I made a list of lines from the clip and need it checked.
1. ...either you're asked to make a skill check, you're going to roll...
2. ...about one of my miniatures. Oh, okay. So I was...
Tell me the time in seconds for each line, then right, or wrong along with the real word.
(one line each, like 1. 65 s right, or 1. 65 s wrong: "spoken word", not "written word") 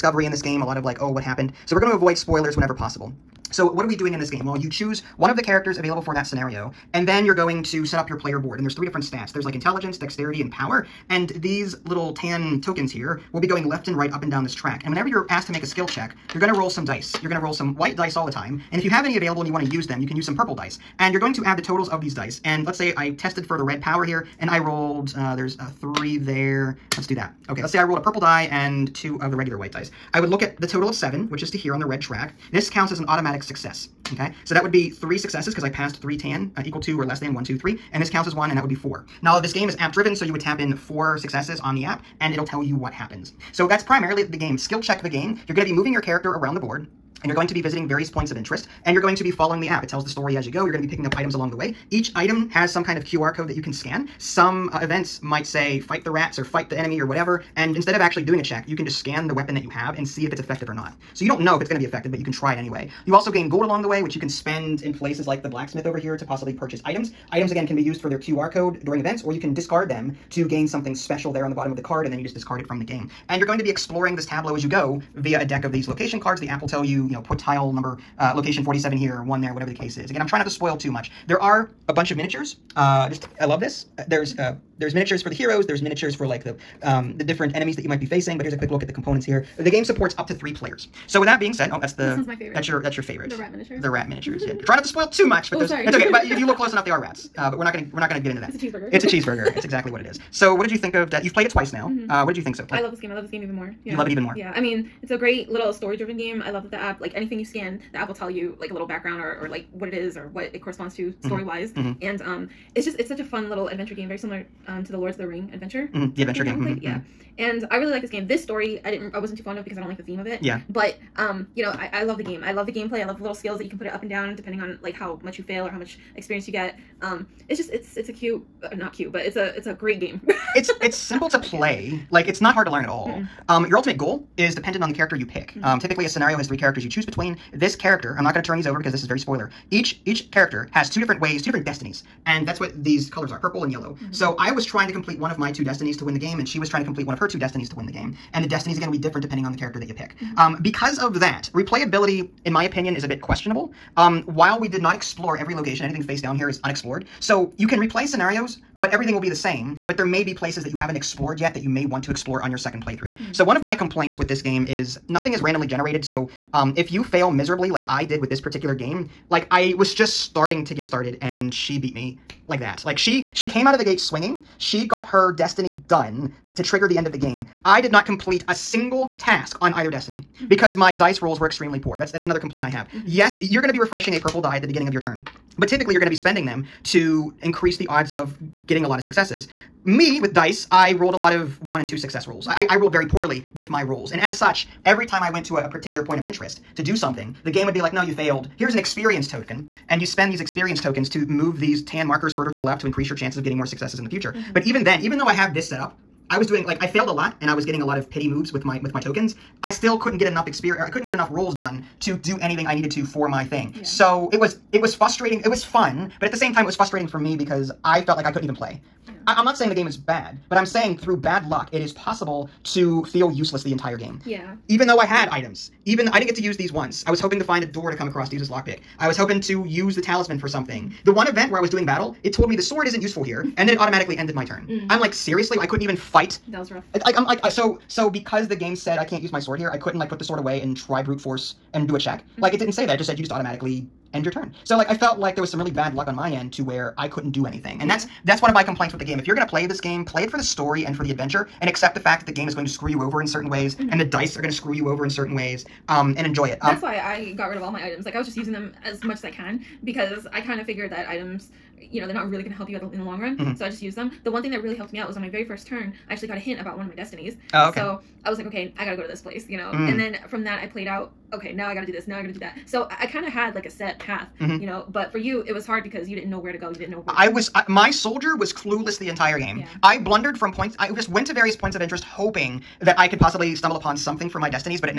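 1. 14 s wrong: "whenever", not "either"
2. 266 s wrong: "destinies", not "miniatures".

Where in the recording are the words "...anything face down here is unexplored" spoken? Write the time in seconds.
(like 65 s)
155 s.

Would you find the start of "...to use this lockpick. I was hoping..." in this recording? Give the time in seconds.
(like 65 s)
228 s.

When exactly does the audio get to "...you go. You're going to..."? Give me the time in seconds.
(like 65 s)
50 s.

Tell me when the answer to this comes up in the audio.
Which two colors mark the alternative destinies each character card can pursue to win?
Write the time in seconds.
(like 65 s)
143 s.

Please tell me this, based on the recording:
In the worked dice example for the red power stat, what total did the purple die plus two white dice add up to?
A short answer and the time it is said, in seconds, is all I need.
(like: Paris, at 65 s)
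7, at 30 s.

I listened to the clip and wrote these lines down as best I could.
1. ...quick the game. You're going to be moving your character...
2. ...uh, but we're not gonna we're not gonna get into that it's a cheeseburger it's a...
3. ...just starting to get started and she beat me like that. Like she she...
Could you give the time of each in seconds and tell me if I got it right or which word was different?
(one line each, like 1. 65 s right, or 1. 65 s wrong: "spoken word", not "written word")
1. 44 s wrong: "check", not "quick"
2. 97 s right
3. 169 s right.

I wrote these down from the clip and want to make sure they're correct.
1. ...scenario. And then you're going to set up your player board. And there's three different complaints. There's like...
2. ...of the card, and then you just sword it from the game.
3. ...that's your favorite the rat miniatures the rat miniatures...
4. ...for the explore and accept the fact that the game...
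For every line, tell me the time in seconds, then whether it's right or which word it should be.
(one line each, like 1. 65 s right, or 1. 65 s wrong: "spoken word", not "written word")
1. 6 s wrong: "stats", not "complaints"
2. 71 s wrong: "discard", not "sword"
3. 92 s right
4. 250 s wrong: "adventure", not "explore".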